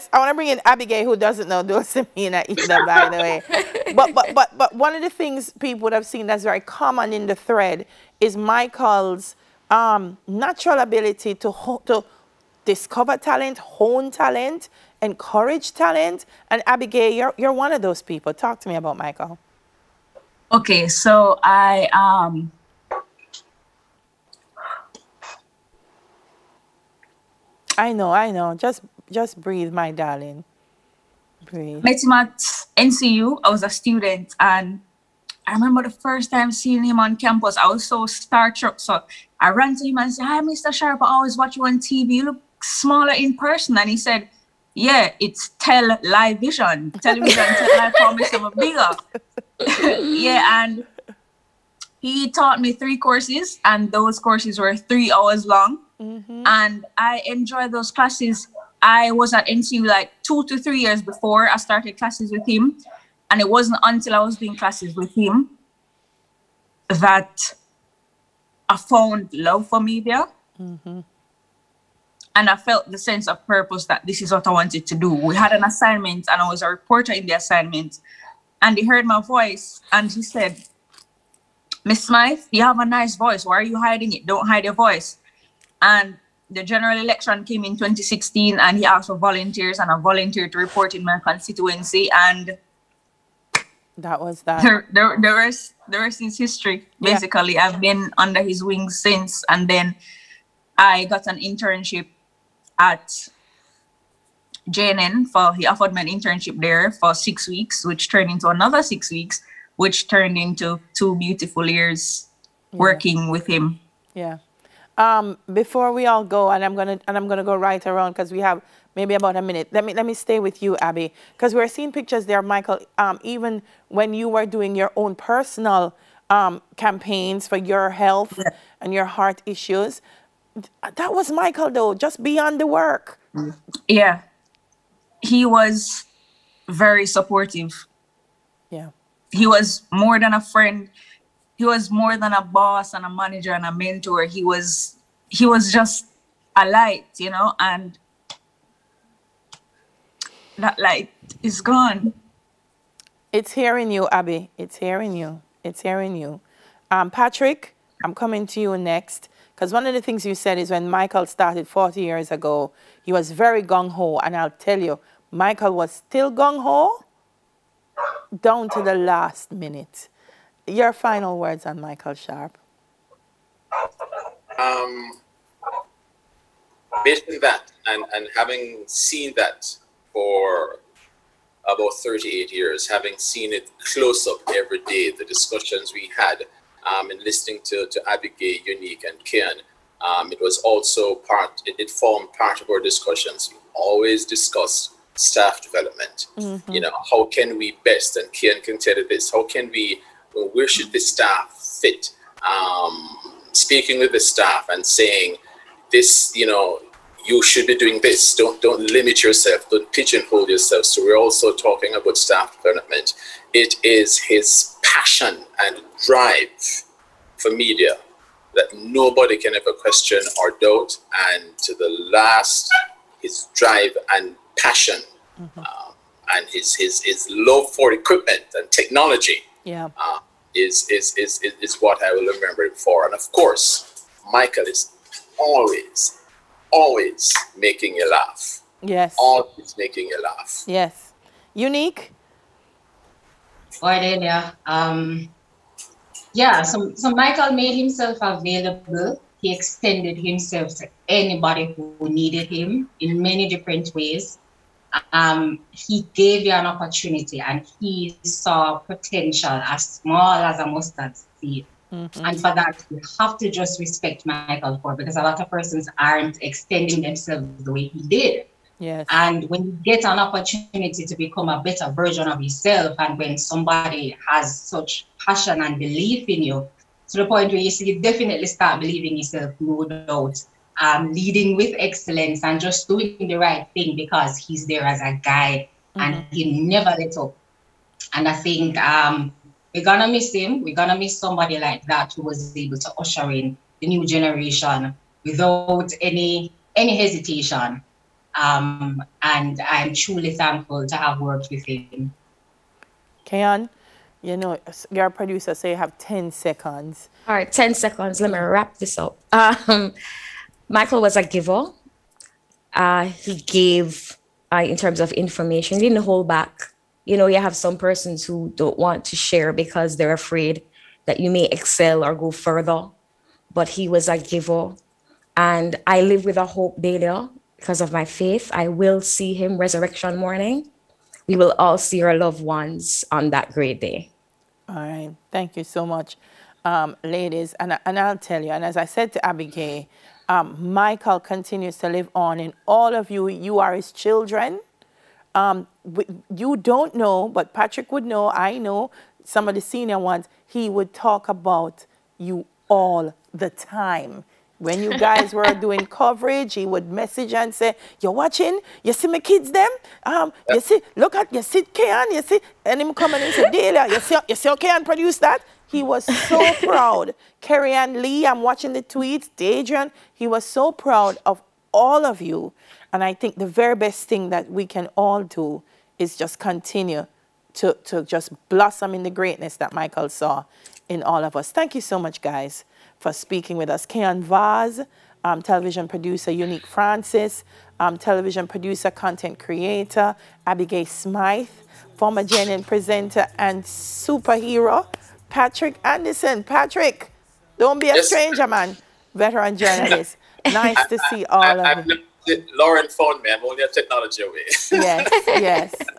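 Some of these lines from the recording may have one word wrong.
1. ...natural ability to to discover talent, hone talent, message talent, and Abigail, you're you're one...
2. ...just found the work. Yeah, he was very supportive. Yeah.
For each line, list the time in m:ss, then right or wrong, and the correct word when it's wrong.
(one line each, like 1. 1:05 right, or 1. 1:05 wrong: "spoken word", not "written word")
1. 0:10 wrong: "encourage", not "message"
2. 2:11 wrong: "beyond", not "found".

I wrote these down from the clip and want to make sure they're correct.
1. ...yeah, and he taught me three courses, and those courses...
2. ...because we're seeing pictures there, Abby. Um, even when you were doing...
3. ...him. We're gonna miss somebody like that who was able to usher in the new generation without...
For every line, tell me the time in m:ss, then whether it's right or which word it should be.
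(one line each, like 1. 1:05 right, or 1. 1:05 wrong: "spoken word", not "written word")
1. 0:50 right
2. 2:01 wrong: "Michael", not "Abby"
3. 4:50 right.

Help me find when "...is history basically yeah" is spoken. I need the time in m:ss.
1:36.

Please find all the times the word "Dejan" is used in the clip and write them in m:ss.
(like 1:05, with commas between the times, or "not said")
6:09.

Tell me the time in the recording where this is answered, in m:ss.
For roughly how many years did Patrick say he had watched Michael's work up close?
3:01.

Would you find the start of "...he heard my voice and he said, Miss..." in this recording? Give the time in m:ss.
1:18.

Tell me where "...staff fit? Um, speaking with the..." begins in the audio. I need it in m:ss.
3:20.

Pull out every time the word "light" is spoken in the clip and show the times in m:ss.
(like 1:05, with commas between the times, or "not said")
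2:26, 2:30.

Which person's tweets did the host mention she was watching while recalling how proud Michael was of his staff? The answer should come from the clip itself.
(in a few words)
Carrie Ann Lee.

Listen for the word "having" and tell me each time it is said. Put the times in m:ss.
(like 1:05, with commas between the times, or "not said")
2:58, 3:02.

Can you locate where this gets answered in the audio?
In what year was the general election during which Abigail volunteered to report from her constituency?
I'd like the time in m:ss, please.
1:27.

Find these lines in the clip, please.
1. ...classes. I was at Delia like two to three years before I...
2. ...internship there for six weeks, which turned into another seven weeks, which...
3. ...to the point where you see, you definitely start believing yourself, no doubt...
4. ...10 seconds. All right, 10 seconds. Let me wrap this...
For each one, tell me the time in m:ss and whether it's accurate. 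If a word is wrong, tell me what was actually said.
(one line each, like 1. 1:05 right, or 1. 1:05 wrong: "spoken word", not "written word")
1. 0:57 wrong: "NCU", not "Delia"
2. 1:46 wrong: "six", not "seven"
3. 4:37 right
4. 5:05 right.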